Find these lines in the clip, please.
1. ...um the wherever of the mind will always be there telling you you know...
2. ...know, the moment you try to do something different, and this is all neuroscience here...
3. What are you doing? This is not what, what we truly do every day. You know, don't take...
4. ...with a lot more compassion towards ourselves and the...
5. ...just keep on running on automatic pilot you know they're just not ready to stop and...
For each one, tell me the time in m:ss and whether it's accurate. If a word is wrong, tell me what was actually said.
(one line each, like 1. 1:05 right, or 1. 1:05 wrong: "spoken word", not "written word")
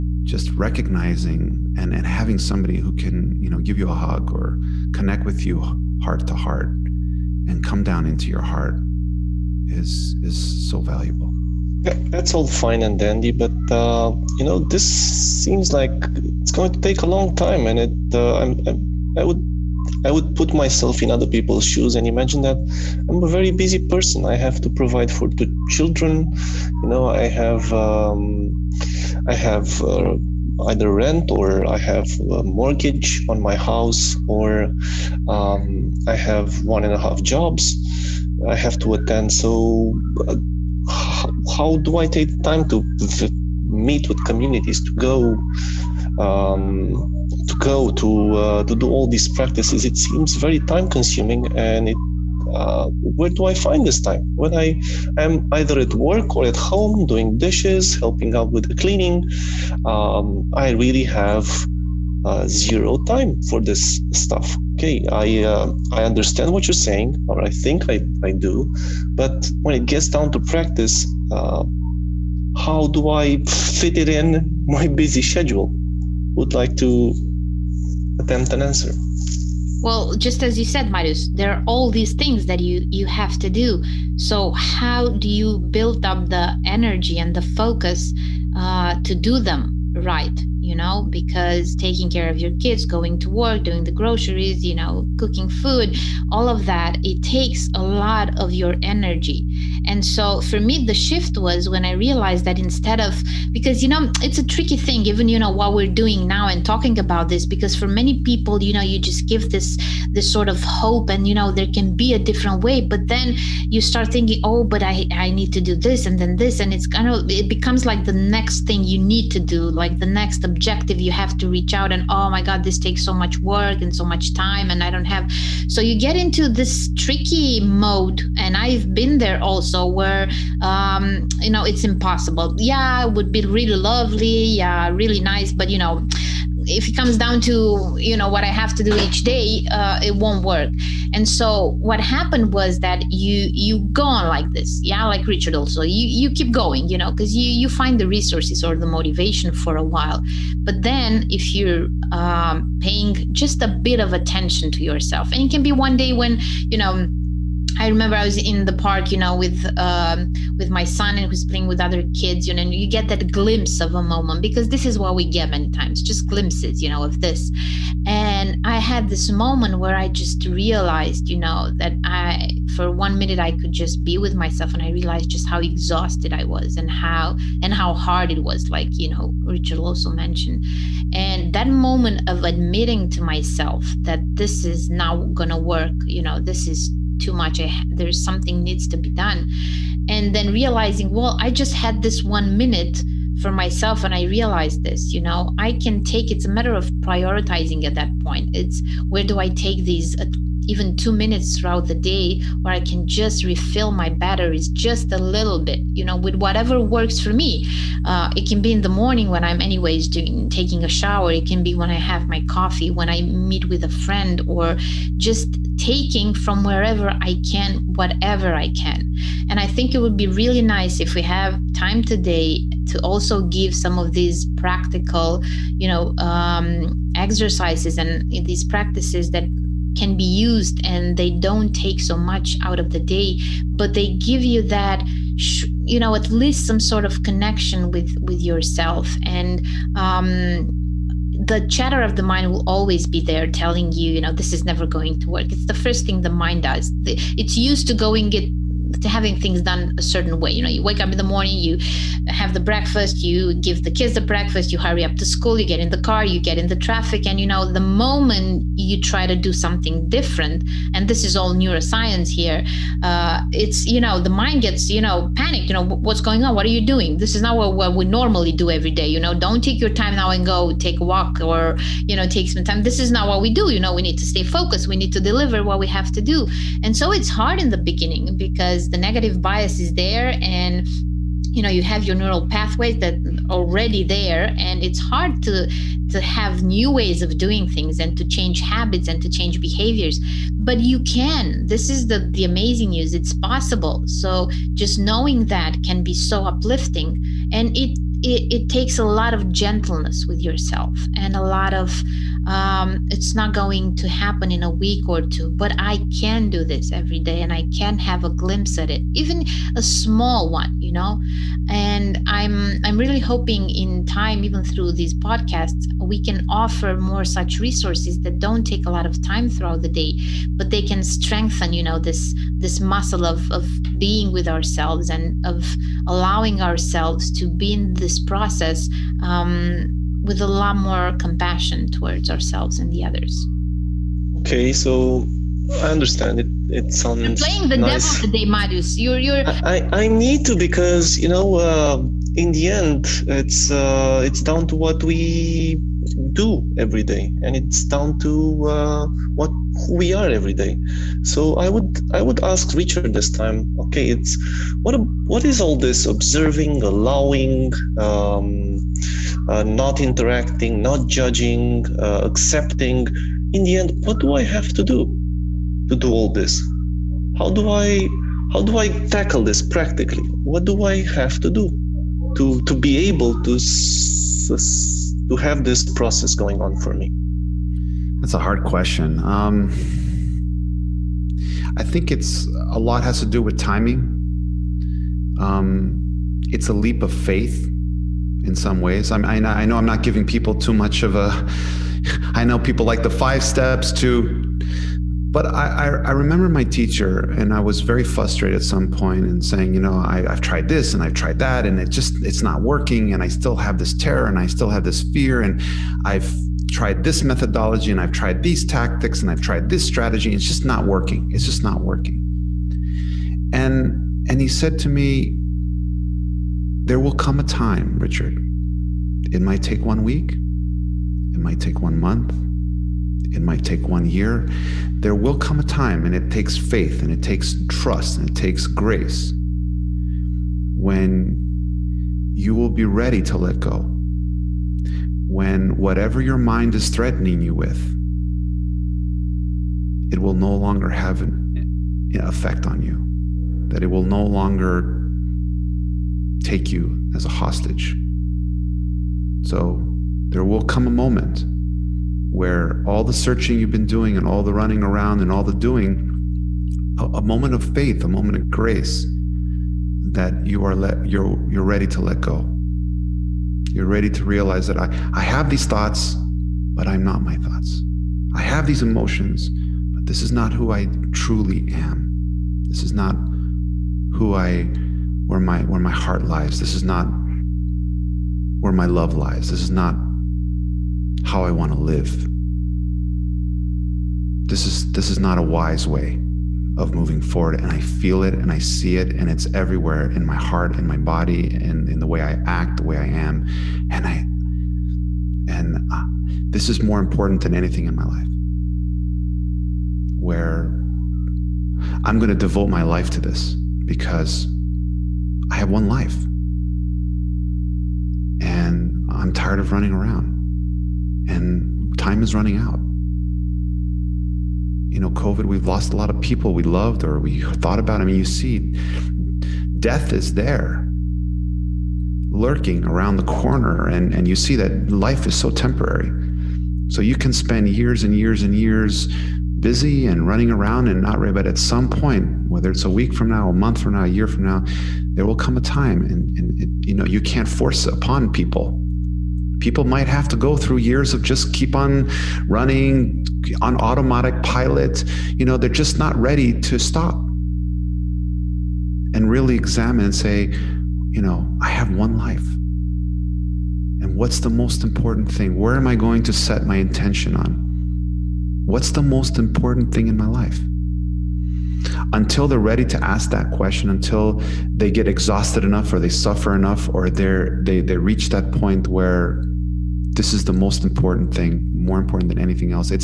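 1. 3:59 wrong: "chatter", not "wherever"
2. 4:17 right
3. 4:26 wrong: "normally", not "truly"
4. 5:30 right
5. 9:01 right.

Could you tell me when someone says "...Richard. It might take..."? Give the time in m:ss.
6:57.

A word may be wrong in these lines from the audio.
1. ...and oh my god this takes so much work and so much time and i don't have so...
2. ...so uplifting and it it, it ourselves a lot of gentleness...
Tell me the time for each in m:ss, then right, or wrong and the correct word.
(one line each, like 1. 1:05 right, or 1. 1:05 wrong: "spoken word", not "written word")
1. 2:01 right
2. 4:56 wrong: "takes", not "ourselves".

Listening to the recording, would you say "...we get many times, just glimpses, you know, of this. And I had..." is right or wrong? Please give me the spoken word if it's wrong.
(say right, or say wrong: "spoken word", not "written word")
right.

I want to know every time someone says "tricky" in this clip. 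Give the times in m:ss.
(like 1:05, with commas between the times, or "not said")
1:44, 2:07.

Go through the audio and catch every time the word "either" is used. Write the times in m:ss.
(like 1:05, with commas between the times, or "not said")
0:30, 0:55.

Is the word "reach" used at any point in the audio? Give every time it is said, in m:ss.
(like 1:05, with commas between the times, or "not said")
2:01, 9:27.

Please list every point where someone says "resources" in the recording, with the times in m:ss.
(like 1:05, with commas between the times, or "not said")
2:28, 5:17.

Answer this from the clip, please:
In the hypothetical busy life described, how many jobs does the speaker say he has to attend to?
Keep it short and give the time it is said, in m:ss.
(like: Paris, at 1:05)
1.5, at 0:36.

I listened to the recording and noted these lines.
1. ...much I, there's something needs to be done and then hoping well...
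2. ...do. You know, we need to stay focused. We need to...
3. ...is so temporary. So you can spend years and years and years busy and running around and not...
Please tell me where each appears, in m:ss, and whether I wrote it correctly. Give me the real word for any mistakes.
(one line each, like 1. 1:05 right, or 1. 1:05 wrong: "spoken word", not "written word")
1. 3:07 wrong: "realizing", not "hoping"
2. 4:33 right
3. 8:45 right.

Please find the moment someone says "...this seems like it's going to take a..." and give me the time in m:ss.
0:14.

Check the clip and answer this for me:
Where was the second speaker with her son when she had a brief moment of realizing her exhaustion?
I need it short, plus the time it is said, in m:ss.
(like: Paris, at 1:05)
the park, at 2:38.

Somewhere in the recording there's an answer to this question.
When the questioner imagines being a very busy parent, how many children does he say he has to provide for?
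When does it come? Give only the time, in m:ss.
0:25.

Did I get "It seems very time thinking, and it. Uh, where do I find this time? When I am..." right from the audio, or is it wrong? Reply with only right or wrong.
wrong.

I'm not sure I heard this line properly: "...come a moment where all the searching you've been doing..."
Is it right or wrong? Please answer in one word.
right.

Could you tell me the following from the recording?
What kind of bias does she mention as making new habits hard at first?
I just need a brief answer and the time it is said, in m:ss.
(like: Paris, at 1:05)
negative bias, at 4:38.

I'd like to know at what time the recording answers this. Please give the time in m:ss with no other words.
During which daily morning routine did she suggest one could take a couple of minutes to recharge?
3:30.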